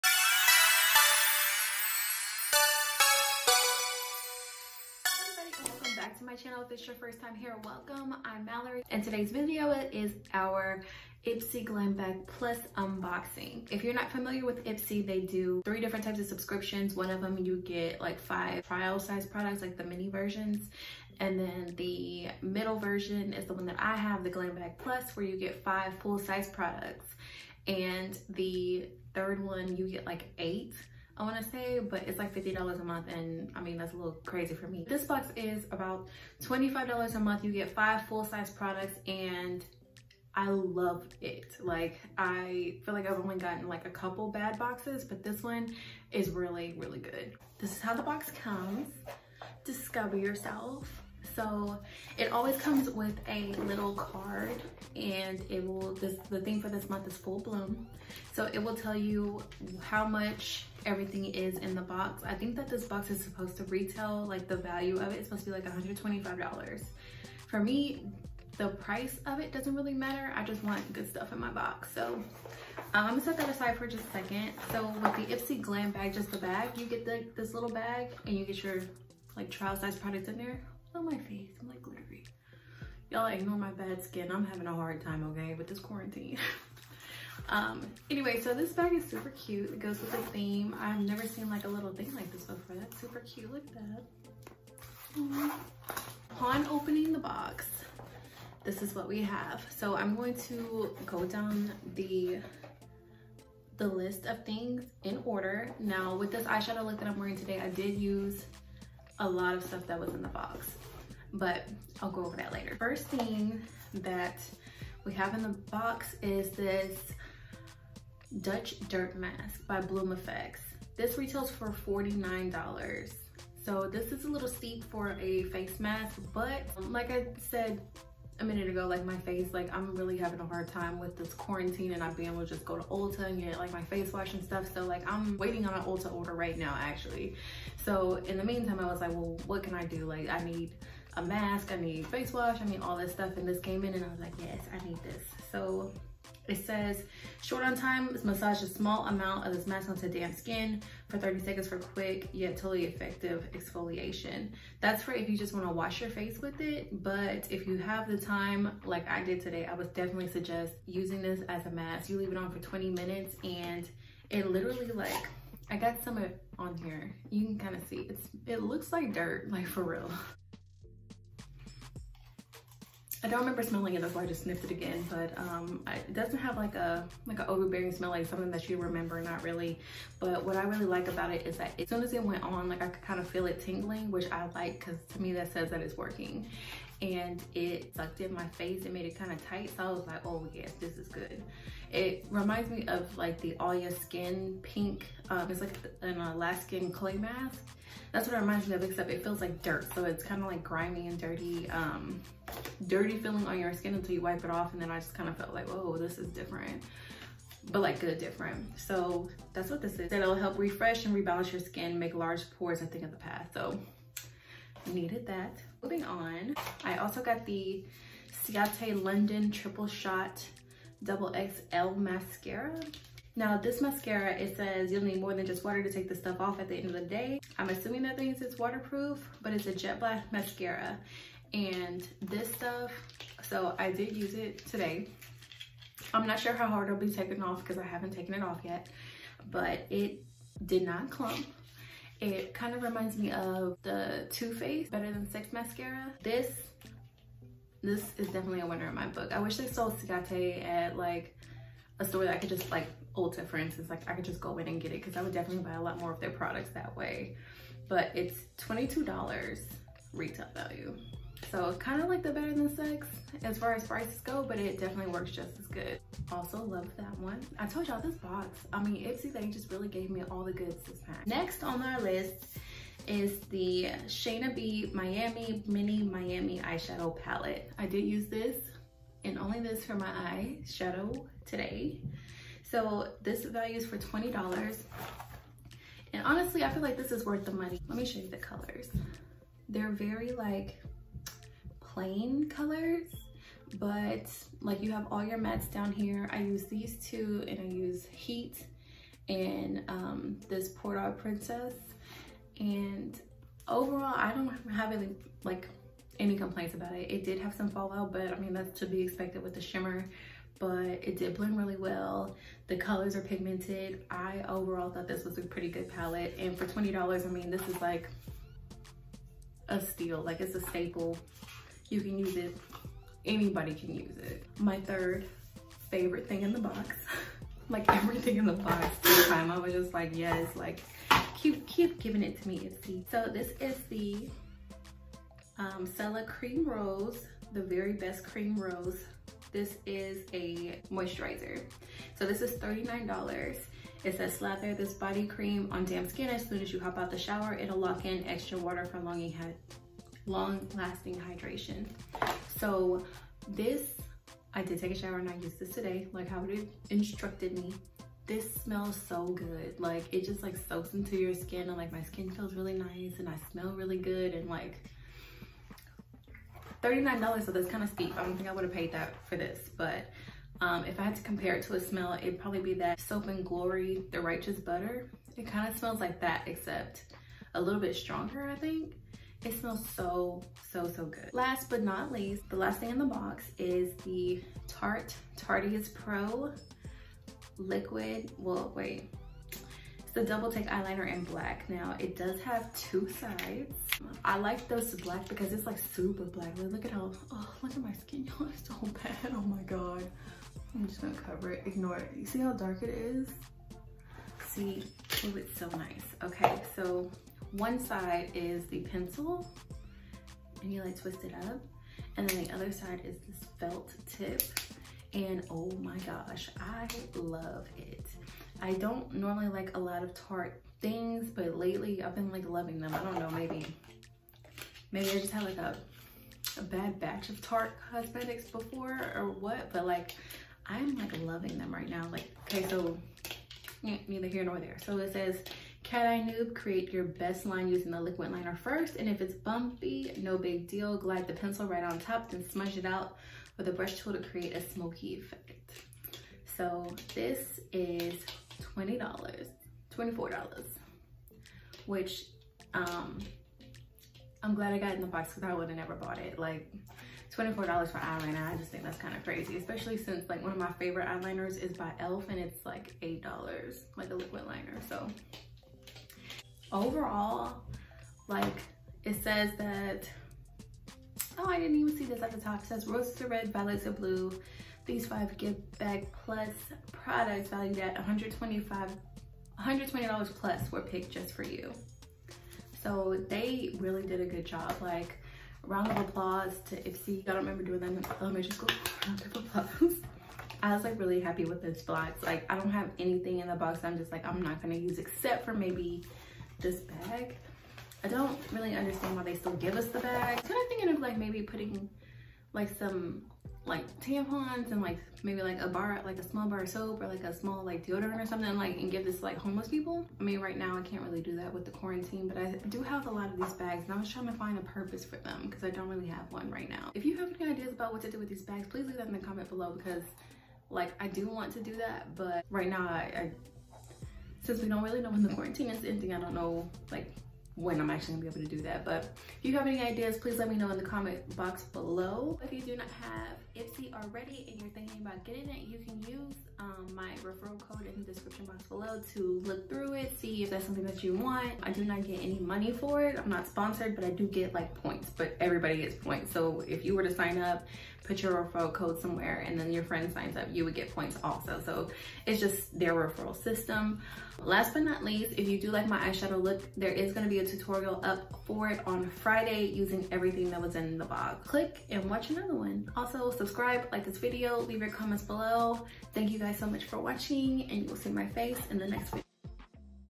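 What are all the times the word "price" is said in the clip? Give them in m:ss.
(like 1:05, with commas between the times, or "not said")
1:08, 4:23.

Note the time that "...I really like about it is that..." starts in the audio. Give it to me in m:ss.
3:00.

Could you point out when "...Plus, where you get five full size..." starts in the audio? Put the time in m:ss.
0:24.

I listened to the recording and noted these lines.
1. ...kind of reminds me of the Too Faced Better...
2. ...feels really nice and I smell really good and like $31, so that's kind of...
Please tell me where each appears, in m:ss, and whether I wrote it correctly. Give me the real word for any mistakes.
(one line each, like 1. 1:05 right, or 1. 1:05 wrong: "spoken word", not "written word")
1. 4:02 right
2. 6:02 wrong: "39", not "31".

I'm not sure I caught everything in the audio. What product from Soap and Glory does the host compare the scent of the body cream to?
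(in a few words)
Righteous Butter.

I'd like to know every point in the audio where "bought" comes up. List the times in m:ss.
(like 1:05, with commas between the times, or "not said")
7:35.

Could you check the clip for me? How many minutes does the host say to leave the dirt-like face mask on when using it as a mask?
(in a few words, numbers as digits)
20.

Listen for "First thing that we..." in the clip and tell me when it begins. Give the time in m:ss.
1:52.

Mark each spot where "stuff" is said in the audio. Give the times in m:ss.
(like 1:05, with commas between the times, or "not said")
1:11, 1:49, 2:14, 2:23, 3:46, 3:52.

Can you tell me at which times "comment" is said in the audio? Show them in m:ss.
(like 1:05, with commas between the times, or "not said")
8:39, 8:50, 9:24.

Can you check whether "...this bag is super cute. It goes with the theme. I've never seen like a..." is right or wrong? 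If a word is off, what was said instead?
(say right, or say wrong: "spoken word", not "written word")
right.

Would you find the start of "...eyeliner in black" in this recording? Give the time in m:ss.
6:30.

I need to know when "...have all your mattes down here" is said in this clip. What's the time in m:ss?
4:54.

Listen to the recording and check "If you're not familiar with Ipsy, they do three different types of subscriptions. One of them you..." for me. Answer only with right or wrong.
right.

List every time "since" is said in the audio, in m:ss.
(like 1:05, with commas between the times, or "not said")
7:39, 8:44.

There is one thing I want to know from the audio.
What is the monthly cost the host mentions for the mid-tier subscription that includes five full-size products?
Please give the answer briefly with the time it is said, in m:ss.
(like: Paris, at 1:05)
$25, at 0:36.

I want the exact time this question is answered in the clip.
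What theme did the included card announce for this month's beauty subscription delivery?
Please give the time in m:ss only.
0:57.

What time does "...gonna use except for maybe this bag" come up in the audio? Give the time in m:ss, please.
8:14.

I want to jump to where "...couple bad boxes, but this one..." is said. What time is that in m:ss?
0:43.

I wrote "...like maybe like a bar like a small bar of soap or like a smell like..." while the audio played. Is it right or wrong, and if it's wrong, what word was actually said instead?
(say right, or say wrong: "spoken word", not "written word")
wrong: "small", not "smell".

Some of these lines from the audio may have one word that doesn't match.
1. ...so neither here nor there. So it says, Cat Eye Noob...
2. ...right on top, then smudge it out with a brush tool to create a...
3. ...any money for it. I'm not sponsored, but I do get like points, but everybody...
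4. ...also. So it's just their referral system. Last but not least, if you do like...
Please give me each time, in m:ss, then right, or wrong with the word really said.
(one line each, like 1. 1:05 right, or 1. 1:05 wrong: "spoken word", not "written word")
1. 7:12 right
2. 7:21 right
3. 9:02 right
4. 9:11 right.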